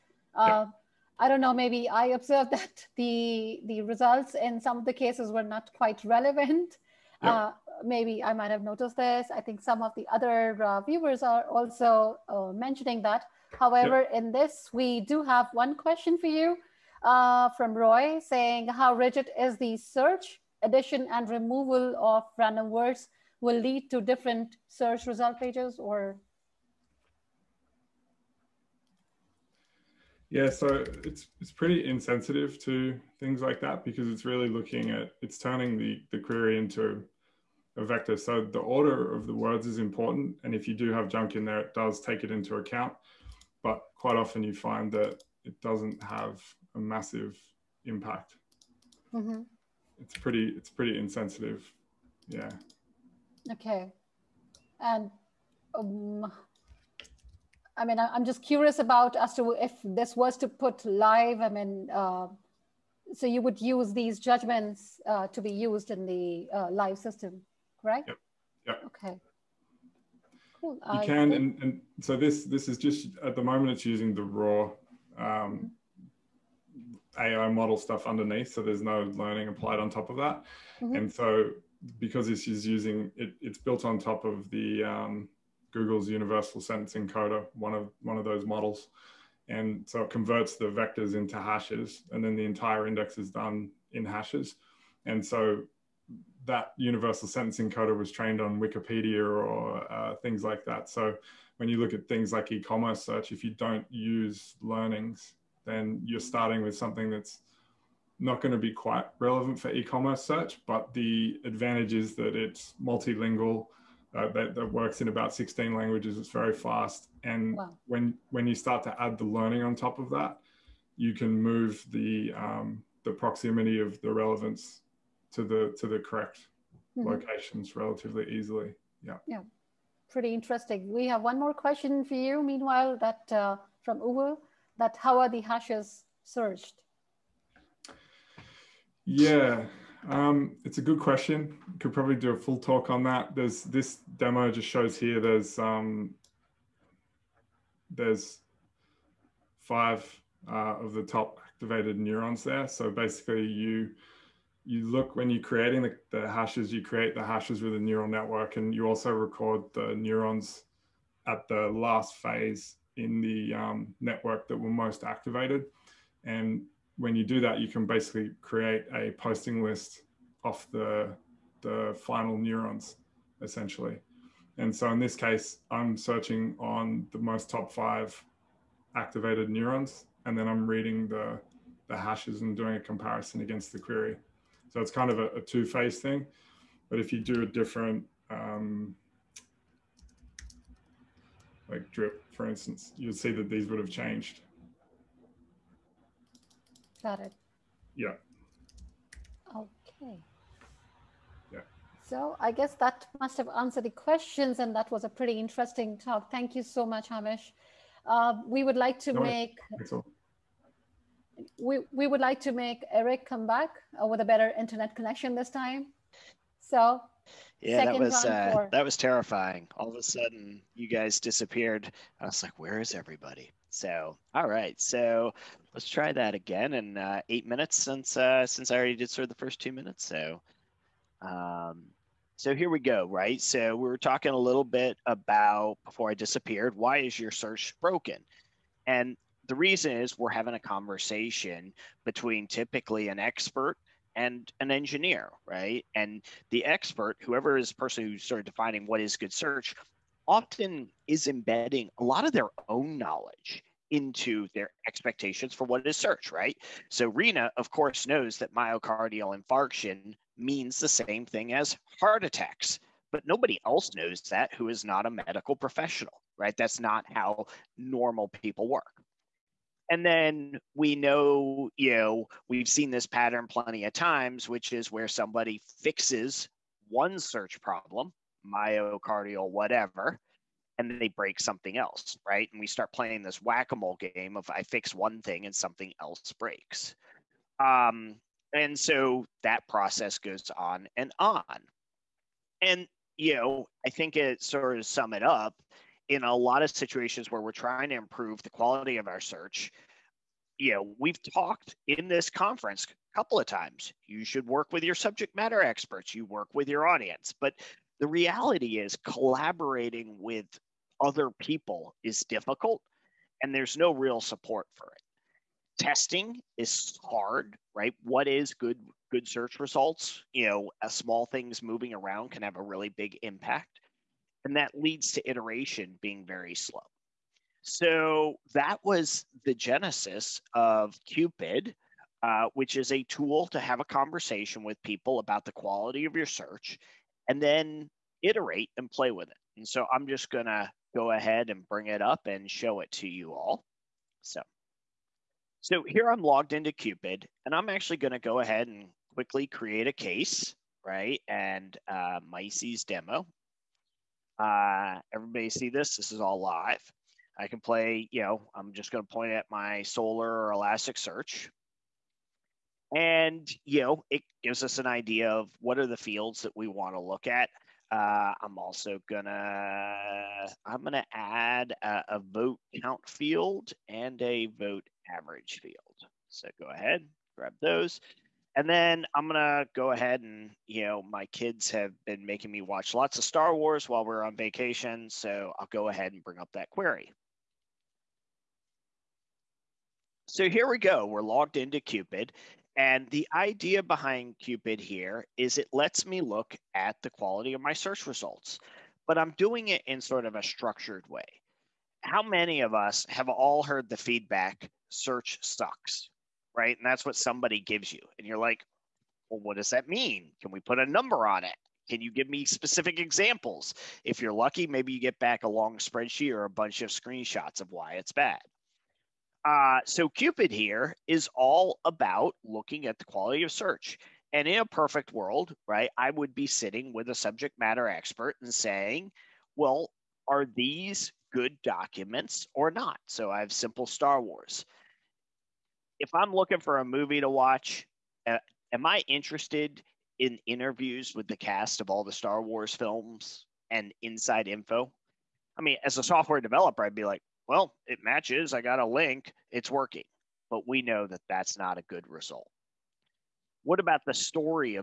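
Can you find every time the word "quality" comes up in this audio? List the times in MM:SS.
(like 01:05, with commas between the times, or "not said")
04:58, 05:35, 06:37, 07:03.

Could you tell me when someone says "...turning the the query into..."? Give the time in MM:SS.
00:35.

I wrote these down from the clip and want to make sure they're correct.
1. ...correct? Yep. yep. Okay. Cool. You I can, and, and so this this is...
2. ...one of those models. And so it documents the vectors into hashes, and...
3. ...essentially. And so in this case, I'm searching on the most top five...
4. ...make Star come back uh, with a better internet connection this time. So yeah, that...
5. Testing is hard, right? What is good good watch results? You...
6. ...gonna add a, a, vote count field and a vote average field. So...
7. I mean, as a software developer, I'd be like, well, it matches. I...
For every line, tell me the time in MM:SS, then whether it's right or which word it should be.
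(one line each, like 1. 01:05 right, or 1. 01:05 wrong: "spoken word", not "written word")
1. 01:07 right
2. 01:28 wrong: "converts", not "documents"
3. 02:53 right
4. 03:32 wrong: "Eric", not "Star"
5. 05:15 wrong: "search", not "watch"
6. 06:10 right
7. 07:25 right.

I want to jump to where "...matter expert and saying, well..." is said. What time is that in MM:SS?
07:07.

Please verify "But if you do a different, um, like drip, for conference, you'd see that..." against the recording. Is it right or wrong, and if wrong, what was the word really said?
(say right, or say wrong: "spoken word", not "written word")
wrong: "instance", not "conference".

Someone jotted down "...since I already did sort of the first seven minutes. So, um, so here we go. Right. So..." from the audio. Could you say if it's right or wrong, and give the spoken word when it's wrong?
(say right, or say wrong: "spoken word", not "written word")
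wrong: "two", not "seven".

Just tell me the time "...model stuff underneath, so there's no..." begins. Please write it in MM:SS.
01:17.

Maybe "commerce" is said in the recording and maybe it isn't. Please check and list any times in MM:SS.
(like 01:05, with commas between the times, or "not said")
01:42, 01:49.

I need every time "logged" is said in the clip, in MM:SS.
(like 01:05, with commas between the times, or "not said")
05:46, 06:31.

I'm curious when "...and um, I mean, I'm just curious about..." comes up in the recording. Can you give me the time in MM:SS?
00:54.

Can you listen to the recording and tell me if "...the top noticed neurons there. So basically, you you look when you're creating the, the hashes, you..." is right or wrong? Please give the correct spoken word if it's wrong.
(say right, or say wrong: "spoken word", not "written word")
wrong: "activated", not "noticed".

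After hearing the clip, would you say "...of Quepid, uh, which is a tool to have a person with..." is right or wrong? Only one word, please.
wrong.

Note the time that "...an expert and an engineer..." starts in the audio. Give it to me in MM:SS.
04:03.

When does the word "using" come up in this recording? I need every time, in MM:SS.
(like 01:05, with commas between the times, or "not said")
01:13, 01:22.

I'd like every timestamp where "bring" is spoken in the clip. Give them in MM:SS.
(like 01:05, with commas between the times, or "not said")
05:41, 06:26.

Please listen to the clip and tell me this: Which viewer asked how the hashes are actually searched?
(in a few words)
Uwe.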